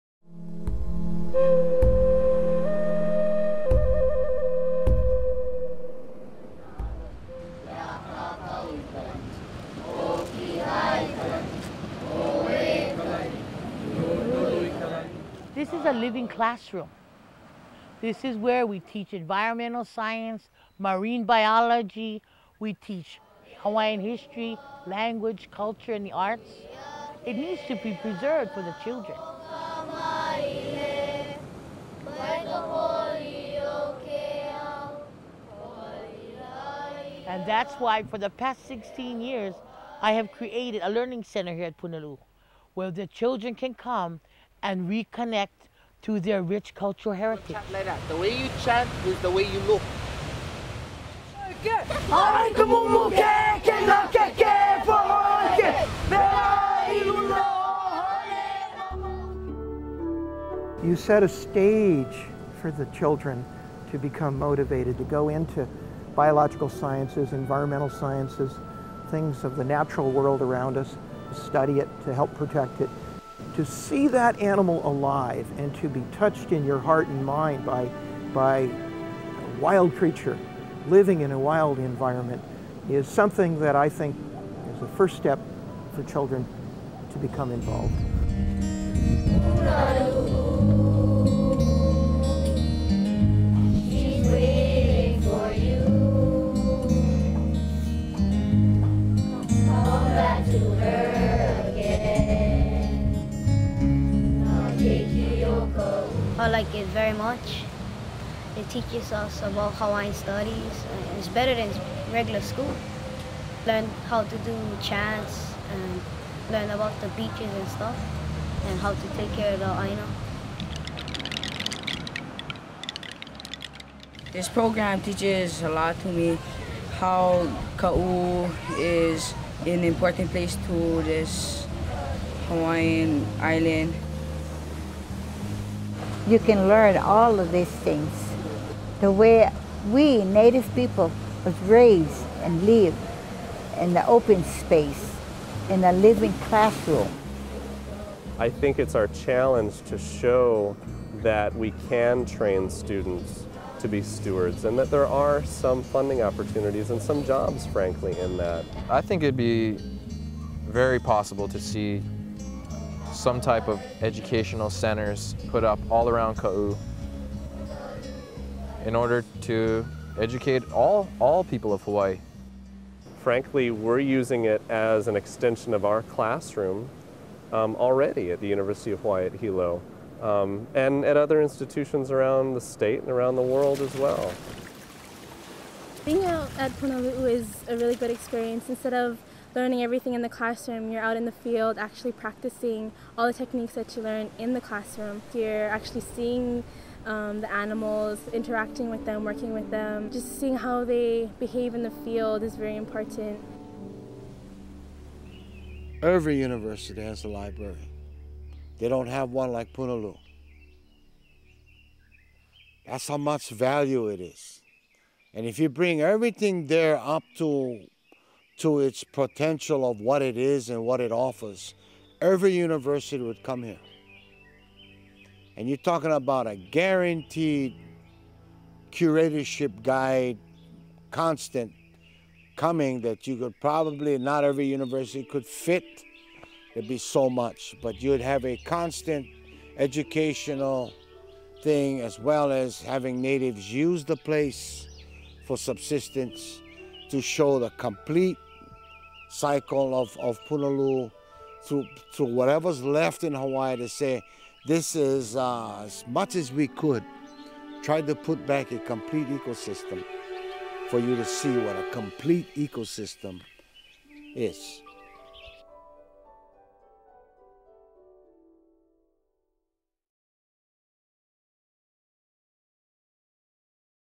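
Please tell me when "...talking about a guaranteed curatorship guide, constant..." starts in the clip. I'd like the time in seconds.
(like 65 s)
225 s.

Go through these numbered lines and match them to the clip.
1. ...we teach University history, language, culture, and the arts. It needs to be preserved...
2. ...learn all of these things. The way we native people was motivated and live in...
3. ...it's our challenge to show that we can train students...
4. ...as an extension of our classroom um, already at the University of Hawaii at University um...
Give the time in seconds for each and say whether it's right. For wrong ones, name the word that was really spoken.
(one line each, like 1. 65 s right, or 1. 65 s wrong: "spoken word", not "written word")
1. 22 s wrong: "Hawaiian", not "University"
2. 136 s wrong: "raised", not "motivated"
3. 148 s right
4. 174 s wrong: "Hilo", not "University".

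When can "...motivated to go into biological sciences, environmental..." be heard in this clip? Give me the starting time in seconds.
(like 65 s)
64 s.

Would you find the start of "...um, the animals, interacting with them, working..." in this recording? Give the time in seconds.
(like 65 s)
197 s.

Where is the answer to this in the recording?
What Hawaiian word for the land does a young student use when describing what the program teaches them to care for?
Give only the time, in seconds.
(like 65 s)
119 s.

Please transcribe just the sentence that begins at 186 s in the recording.
Being out at Punalu'u is a really good experience.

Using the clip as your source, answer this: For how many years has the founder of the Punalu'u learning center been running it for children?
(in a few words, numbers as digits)
16 years.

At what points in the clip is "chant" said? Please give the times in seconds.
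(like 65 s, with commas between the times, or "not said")
48 s, 114 s.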